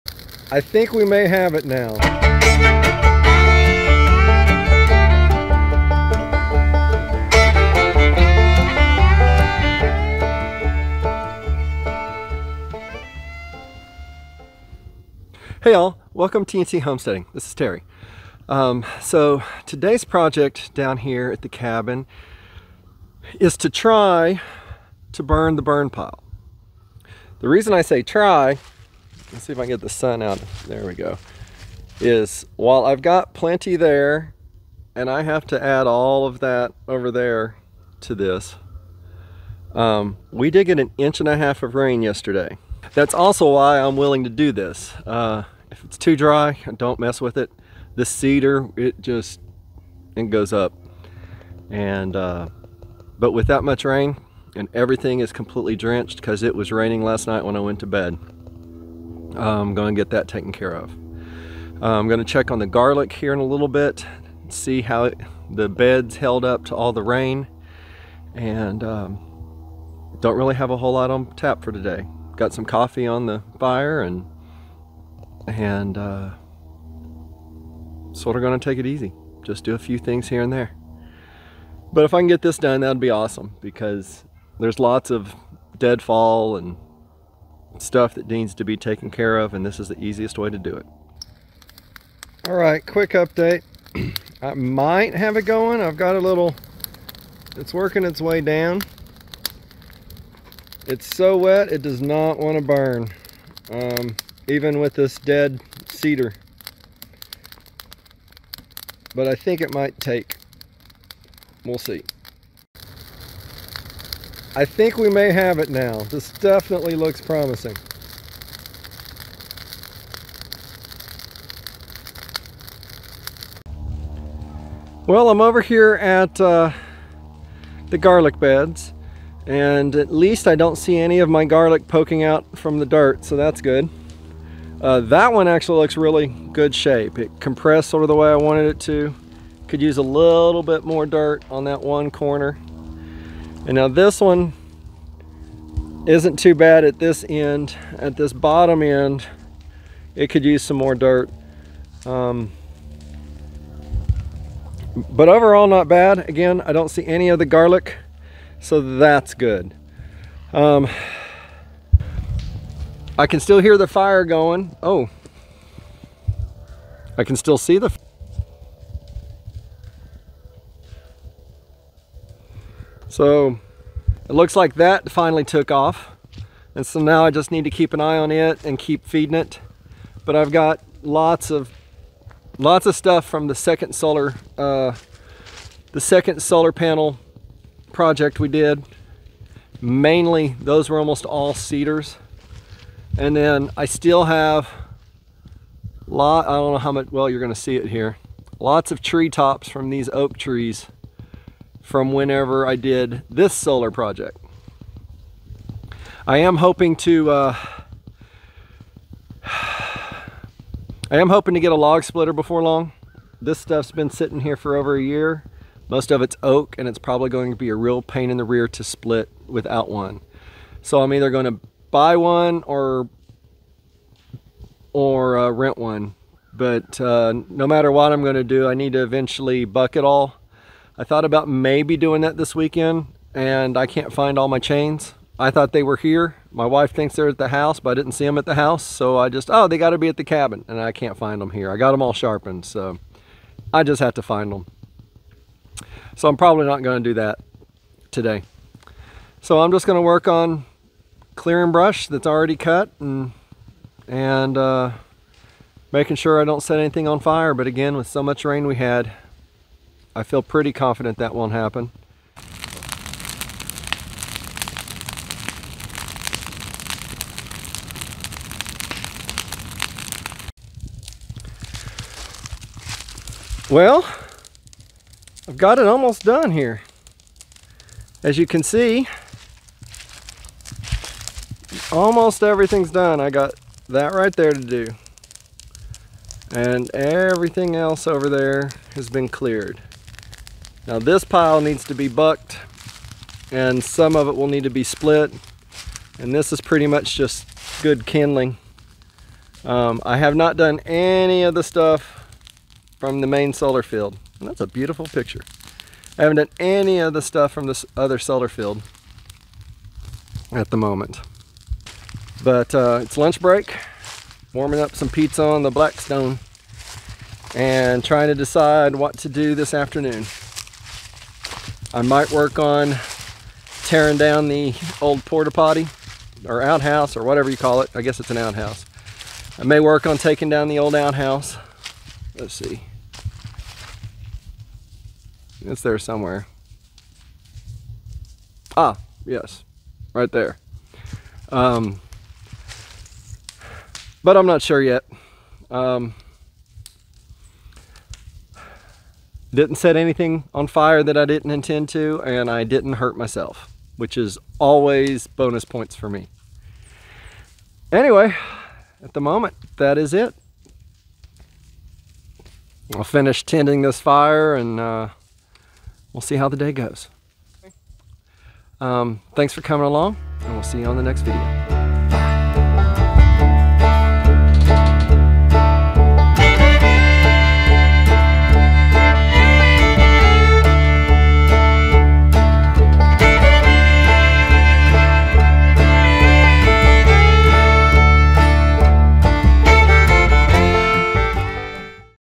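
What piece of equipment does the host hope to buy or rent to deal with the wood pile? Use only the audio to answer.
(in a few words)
Log splitter.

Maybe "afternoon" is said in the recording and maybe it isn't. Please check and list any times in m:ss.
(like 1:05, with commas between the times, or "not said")
5:19.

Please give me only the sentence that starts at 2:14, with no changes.
Uh, that one actually looks really good shape.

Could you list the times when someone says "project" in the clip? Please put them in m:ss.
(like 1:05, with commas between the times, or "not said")
0:20, 3:07, 3:23.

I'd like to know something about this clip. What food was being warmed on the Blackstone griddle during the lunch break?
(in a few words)
Pizza.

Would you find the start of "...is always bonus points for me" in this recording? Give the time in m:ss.
5:54.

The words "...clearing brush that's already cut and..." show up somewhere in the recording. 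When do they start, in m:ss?
4:11.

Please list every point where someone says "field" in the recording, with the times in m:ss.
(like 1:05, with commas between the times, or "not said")
5:03, 5:08.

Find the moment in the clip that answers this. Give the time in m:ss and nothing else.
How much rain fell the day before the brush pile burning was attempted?
0:40.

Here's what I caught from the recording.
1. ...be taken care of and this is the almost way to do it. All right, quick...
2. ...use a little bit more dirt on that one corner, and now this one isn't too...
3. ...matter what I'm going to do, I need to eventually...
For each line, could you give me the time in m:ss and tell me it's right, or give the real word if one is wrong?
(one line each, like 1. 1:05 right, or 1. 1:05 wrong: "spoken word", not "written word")
1. 1:28 wrong: "easiest", not "almost"
2. 2:19 right
3. 3:47 right.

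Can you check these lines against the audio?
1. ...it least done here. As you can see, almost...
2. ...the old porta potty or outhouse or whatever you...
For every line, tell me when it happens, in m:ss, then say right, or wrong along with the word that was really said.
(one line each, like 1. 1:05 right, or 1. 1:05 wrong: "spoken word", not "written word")
1. 4:35 wrong: "almost", not "least"
2. 5:24 right.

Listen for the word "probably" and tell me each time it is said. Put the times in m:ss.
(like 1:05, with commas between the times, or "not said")
3:36, 4:06.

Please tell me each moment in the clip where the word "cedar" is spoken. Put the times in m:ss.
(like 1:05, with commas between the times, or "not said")
0:48, 1:45, 3:11.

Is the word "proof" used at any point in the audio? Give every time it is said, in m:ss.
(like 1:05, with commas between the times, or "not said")
not said.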